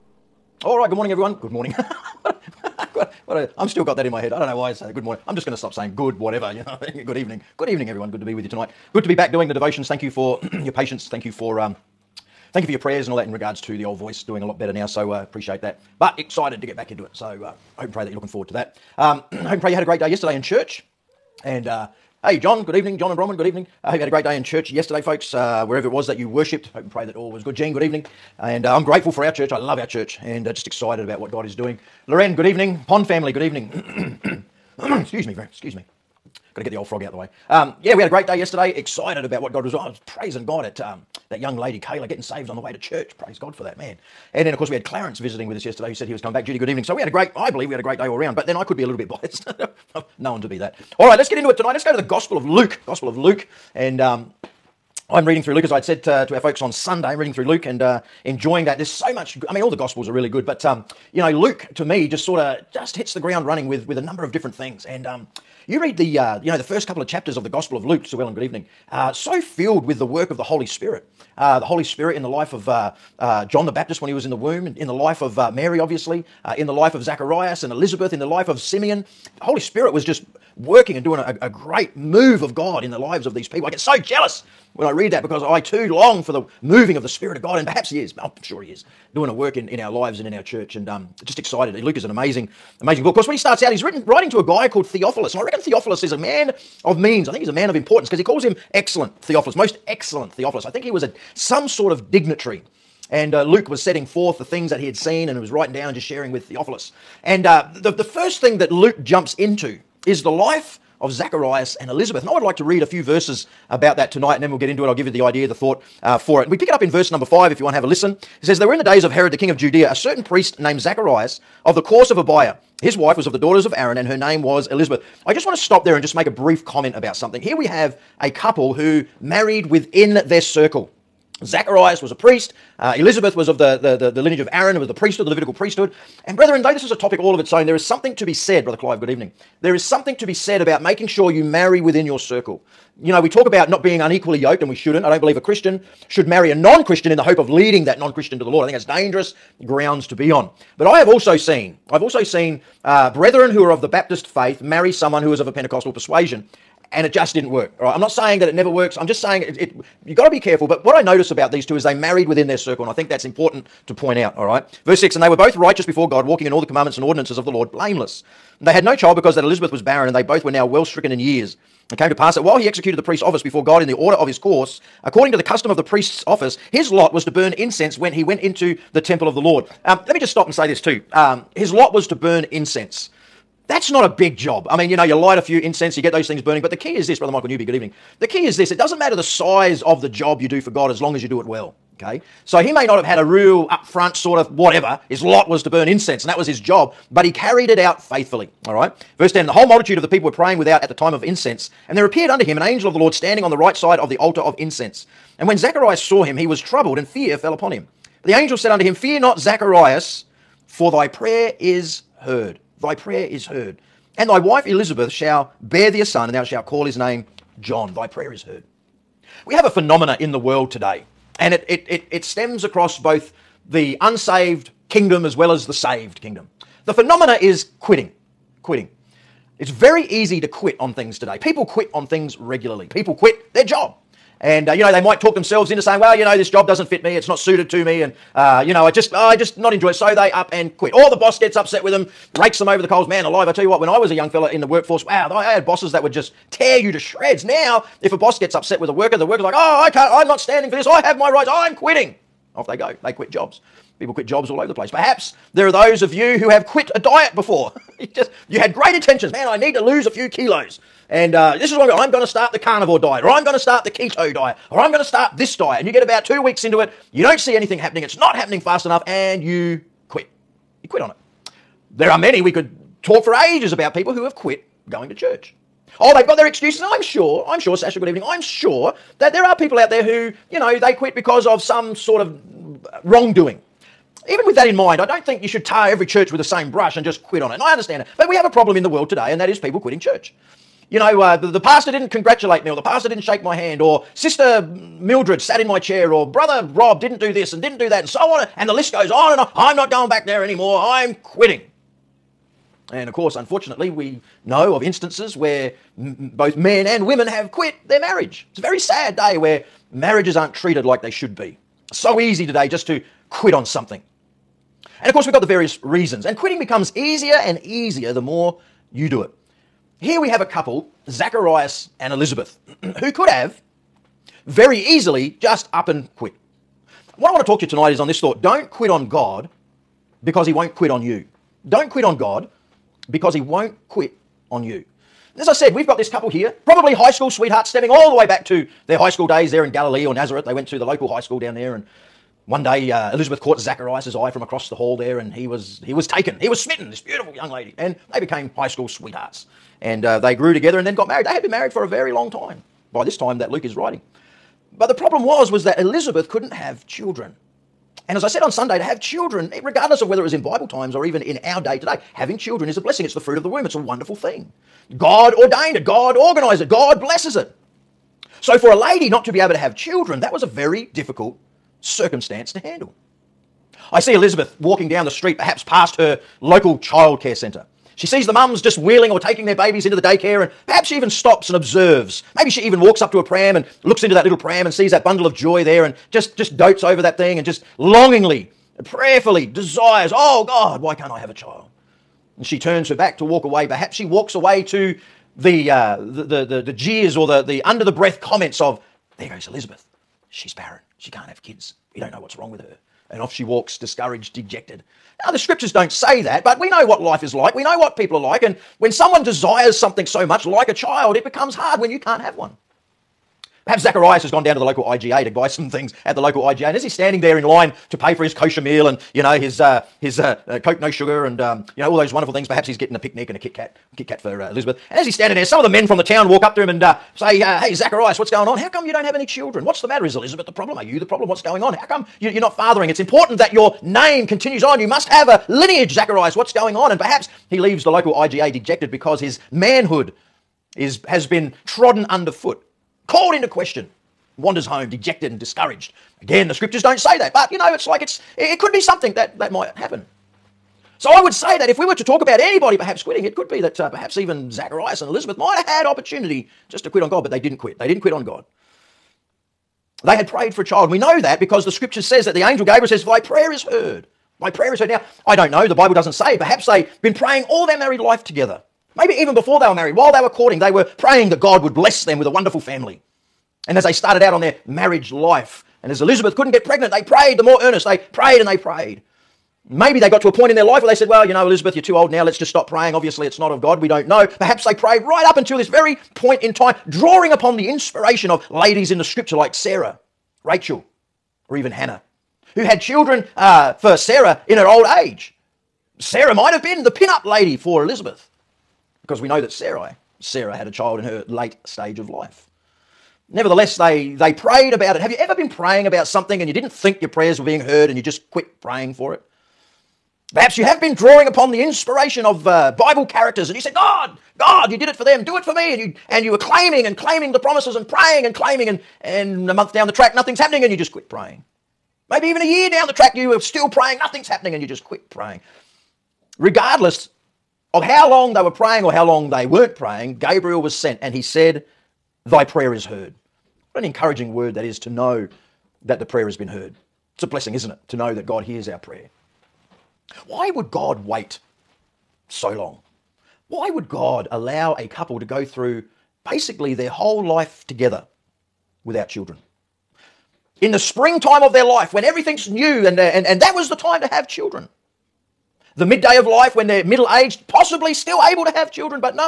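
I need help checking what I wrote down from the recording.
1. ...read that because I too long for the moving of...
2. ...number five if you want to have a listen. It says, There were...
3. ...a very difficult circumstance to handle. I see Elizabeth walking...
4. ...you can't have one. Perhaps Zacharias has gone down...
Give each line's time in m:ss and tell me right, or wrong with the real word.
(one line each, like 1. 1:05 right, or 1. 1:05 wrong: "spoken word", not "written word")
1. 1:24 right
2. 1:57 right
3. 6:10 right
4. 6:51 right.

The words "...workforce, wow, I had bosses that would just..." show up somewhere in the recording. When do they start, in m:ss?
4:04.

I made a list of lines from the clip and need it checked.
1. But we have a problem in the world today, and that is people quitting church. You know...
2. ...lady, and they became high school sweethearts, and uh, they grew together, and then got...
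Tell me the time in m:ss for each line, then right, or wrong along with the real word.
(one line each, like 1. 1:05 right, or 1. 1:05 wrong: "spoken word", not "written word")
1. 4:48 right
2. 5:47 right.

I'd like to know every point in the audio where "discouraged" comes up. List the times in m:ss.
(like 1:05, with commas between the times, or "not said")
6:43, 7:25.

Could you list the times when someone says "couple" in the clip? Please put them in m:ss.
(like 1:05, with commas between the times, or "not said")
1:06, 2:08, 5:20, 5:36, 9:04.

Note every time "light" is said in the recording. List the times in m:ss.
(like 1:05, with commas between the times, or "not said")
3:05.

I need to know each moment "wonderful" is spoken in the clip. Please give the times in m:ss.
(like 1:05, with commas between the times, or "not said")
6:03, 7:02, 7:52.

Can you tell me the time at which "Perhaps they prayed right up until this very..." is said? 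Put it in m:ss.
8:04.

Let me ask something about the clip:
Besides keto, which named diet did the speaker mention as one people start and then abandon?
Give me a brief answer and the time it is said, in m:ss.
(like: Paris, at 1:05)
carnivore diet, at 4:22.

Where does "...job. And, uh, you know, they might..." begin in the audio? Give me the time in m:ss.
3:53.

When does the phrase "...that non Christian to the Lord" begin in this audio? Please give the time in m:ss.
2:27.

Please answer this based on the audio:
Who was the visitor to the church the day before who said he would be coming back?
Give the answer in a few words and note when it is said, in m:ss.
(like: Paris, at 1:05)
Clarence, at 0:44.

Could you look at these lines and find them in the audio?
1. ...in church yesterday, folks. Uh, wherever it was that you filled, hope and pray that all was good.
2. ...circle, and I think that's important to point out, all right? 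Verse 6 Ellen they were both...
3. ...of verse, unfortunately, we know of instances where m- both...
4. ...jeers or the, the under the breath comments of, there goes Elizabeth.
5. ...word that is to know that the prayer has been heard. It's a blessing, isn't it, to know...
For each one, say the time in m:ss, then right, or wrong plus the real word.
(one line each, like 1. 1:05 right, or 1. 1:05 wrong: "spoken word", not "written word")
1. 0:24 wrong: "worshipped", not "filled"
2. 2:42 wrong: "And", not "Ellen"
3. 5:03 wrong: "course", not "verse"
4. 6:36 right
5. 8:54 right.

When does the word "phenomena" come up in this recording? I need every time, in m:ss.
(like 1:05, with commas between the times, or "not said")
3:39, 3:46.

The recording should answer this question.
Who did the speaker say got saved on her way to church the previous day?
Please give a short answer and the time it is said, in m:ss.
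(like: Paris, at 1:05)
Kayla, at 0:41.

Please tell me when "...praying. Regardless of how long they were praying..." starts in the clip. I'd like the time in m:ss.
8:45.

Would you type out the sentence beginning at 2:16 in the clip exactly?
And brethren, though this is a topic all of its own, there is something to be said, Brother Clive, good evening.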